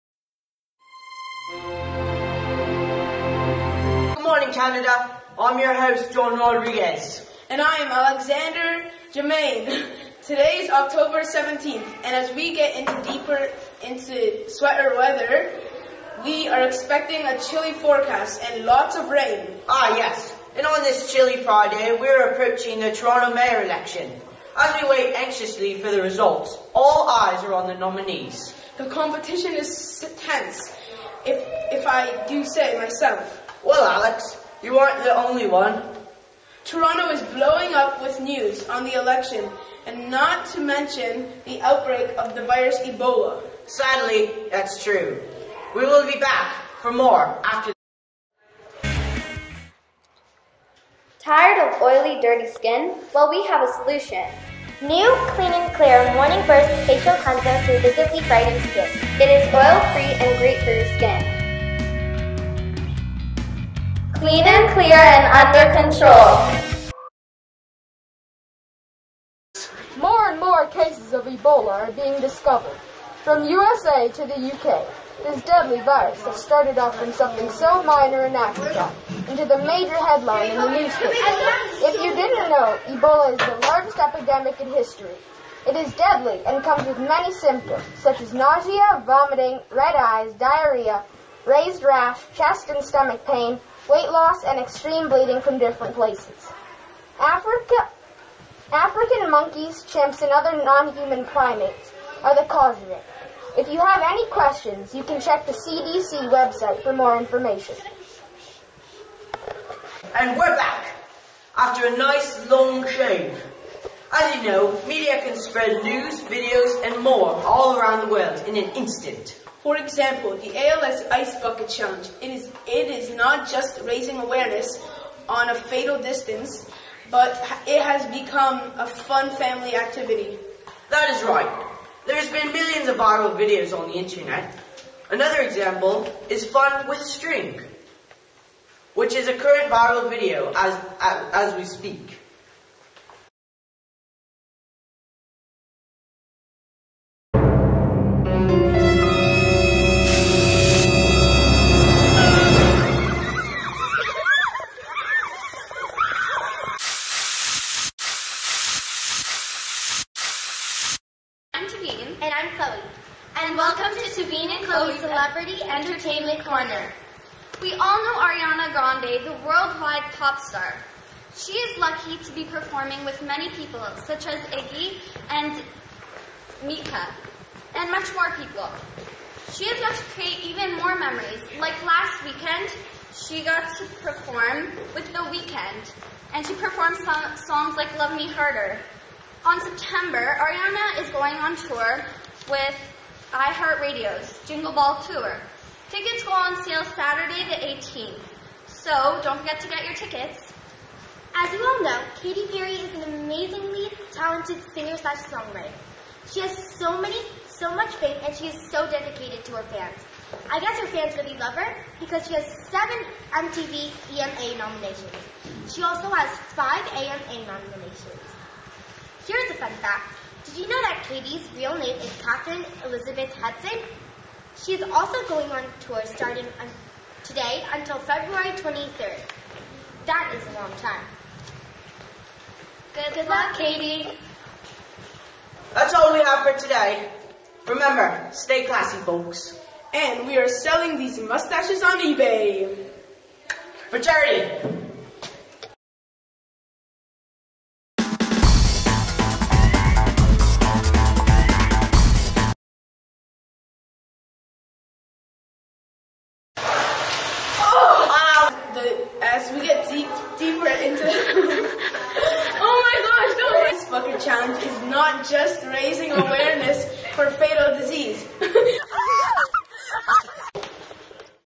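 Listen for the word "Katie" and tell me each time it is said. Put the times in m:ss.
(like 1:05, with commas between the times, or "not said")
3:53.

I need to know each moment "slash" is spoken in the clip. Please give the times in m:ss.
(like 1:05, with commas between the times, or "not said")
3:24.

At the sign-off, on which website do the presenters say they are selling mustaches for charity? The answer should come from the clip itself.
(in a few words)
eBay.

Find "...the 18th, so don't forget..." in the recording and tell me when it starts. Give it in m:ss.
3:17.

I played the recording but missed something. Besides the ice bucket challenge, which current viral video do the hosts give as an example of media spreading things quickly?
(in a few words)
Fun with string.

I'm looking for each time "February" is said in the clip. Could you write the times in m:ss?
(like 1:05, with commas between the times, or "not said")
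3:47.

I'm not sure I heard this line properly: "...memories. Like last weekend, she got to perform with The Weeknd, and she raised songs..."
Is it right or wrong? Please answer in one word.
wrong.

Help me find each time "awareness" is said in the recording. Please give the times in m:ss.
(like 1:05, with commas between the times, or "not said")
2:04, 4:26.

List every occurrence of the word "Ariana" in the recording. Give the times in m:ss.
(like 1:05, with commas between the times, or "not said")
2:48, 3:10.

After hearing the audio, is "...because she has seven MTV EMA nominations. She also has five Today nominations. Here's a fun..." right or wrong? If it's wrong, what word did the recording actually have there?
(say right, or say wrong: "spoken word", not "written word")
wrong: "AMA", not "Today".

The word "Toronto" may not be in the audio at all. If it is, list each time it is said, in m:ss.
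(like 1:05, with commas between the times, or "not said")
0:22, 0:36.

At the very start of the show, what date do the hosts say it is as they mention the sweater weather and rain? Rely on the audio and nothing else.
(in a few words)
October 17.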